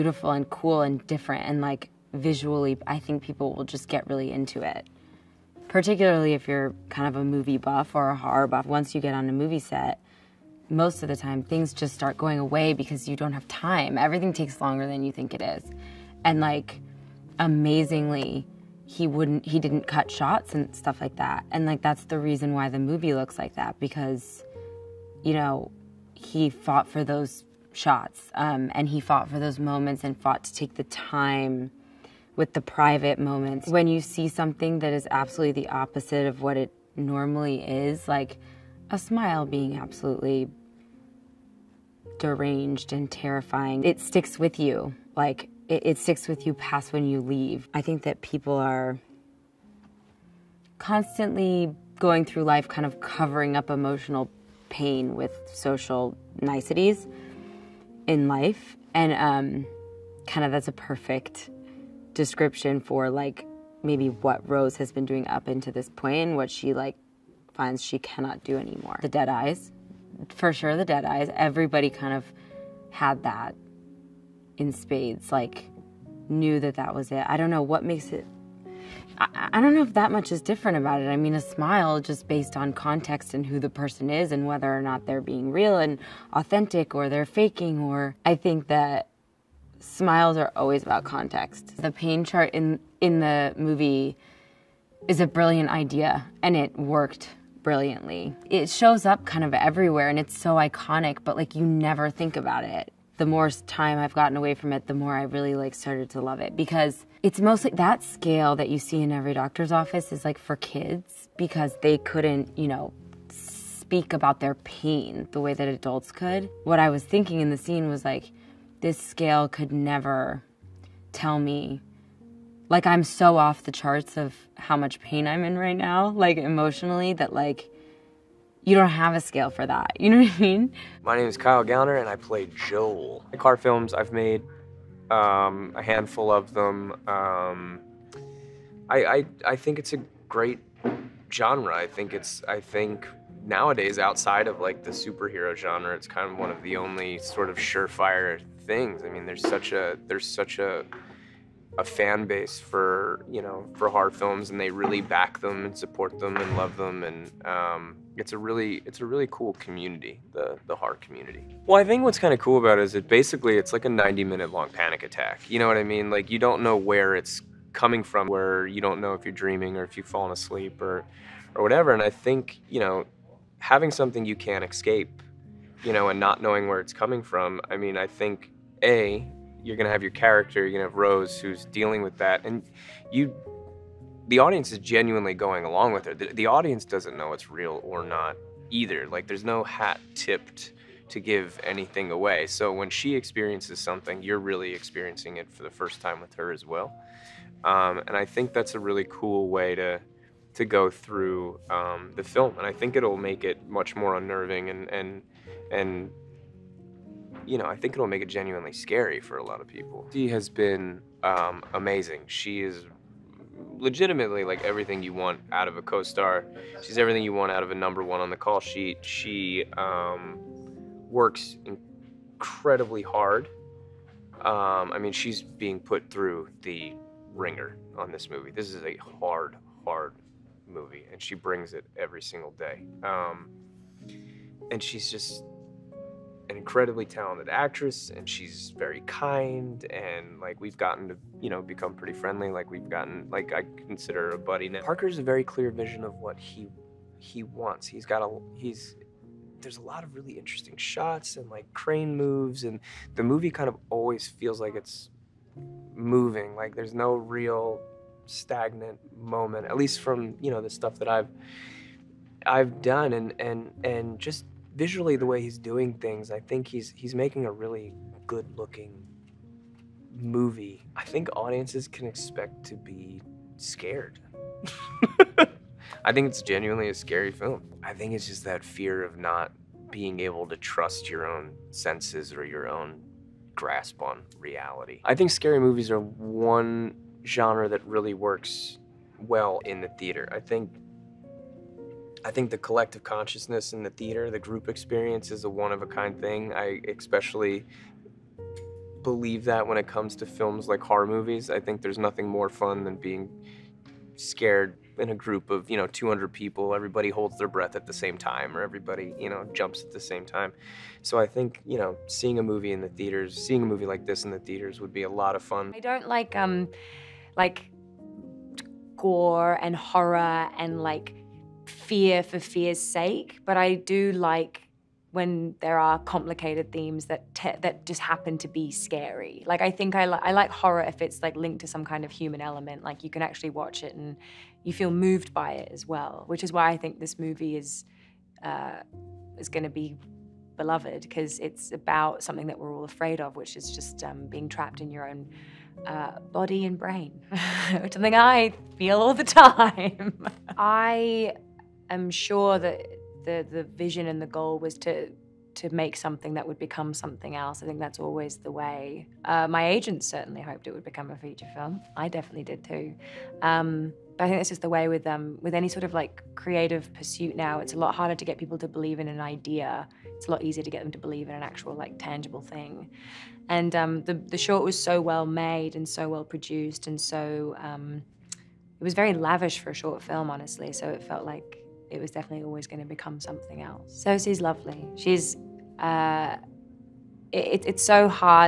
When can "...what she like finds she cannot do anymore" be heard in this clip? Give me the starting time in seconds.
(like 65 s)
66 s.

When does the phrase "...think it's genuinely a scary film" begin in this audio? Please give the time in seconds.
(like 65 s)
276 s.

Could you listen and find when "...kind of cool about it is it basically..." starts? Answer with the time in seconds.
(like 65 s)
162 s.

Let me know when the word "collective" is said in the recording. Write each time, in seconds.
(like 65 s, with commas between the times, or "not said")
292 s.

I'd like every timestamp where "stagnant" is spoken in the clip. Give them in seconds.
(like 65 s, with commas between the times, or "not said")
258 s.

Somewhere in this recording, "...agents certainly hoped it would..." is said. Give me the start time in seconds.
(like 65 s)
359 s.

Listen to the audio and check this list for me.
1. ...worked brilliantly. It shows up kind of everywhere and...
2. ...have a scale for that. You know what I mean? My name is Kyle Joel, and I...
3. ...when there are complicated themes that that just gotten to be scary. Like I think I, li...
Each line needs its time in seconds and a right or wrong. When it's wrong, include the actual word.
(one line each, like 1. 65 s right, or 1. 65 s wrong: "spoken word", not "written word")
1. 96 s right
2. 128 s wrong: "Gallner", not "Joel"
3. 325 s wrong: "happen", not "gotten".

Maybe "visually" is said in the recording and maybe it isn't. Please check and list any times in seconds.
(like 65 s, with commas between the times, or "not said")
2 s, 264 s.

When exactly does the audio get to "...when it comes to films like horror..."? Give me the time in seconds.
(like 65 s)
299 s.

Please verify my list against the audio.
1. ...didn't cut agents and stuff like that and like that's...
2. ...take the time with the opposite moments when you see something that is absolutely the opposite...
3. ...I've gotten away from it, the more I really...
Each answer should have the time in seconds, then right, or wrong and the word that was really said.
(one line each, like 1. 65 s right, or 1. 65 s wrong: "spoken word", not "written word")
1. 19 s wrong: "shots", not "agents"
2. 30 s wrong: "private", not "opposite"
3. 103 s right.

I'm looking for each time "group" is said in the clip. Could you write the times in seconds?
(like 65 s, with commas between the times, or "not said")
294 s, 305 s.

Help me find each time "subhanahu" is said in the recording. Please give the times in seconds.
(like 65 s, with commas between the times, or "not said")
not said.